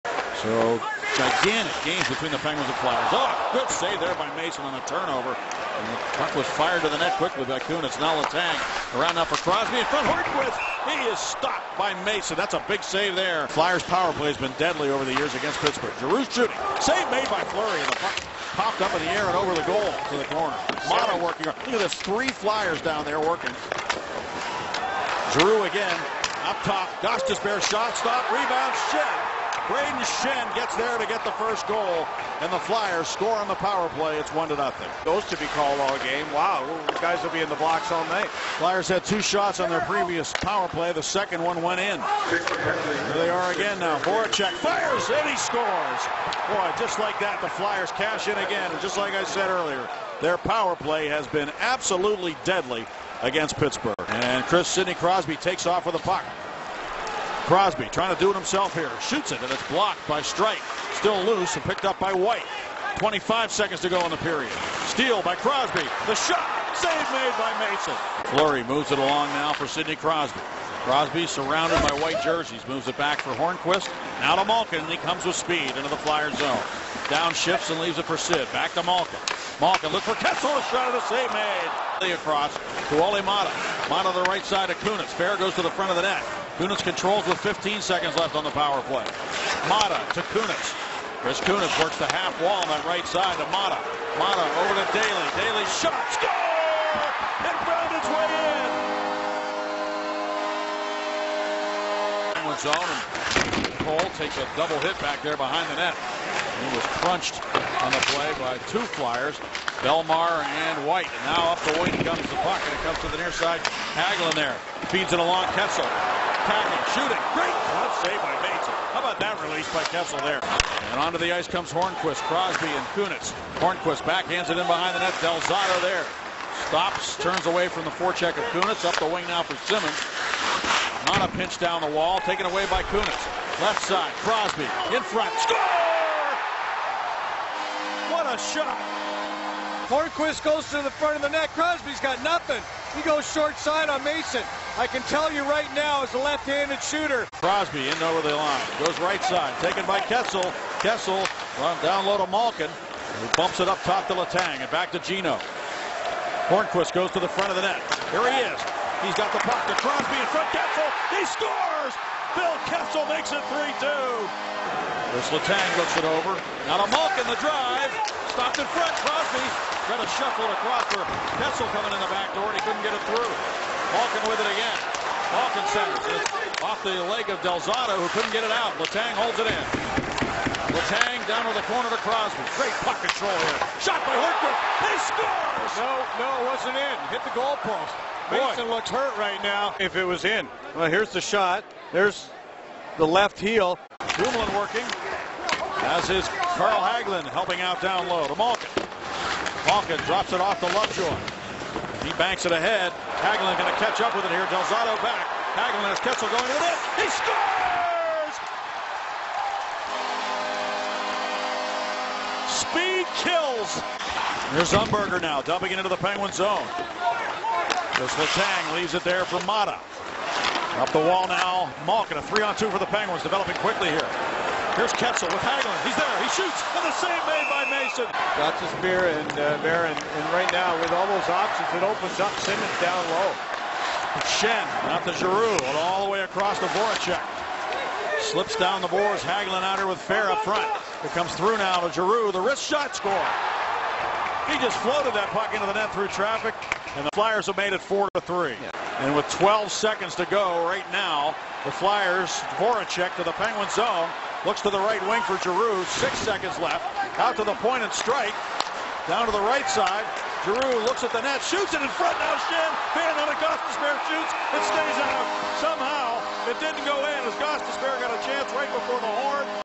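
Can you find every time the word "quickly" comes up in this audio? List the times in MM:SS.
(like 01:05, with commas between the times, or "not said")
00:07, 03:43.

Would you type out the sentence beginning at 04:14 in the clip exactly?
Looks to the right wing for Giroux.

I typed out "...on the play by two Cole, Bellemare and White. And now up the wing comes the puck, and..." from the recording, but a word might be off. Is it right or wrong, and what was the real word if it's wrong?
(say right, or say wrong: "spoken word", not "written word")
wrong: "Flyers", not "Cole".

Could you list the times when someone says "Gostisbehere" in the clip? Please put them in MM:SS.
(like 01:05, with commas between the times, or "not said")
04:23, 04:27.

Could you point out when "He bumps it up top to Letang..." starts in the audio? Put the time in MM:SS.
02:33.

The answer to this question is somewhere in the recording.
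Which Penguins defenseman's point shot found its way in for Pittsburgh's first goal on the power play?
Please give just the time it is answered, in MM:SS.
01:35.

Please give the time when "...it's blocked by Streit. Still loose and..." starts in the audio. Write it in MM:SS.
00:59.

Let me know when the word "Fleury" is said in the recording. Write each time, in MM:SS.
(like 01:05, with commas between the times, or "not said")
00:17, 01:08.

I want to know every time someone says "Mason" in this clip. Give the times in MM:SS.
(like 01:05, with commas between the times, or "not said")
00:04, 00:12, 01:07, 02:24, 03:08, 03:47.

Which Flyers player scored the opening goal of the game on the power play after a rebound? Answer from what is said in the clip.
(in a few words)
Brayden Schenn.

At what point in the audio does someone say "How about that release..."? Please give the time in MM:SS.
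01:58.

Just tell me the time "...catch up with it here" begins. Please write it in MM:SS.
03:23.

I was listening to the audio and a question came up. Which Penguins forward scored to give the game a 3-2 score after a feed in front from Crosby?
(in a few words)
Phil Kessel.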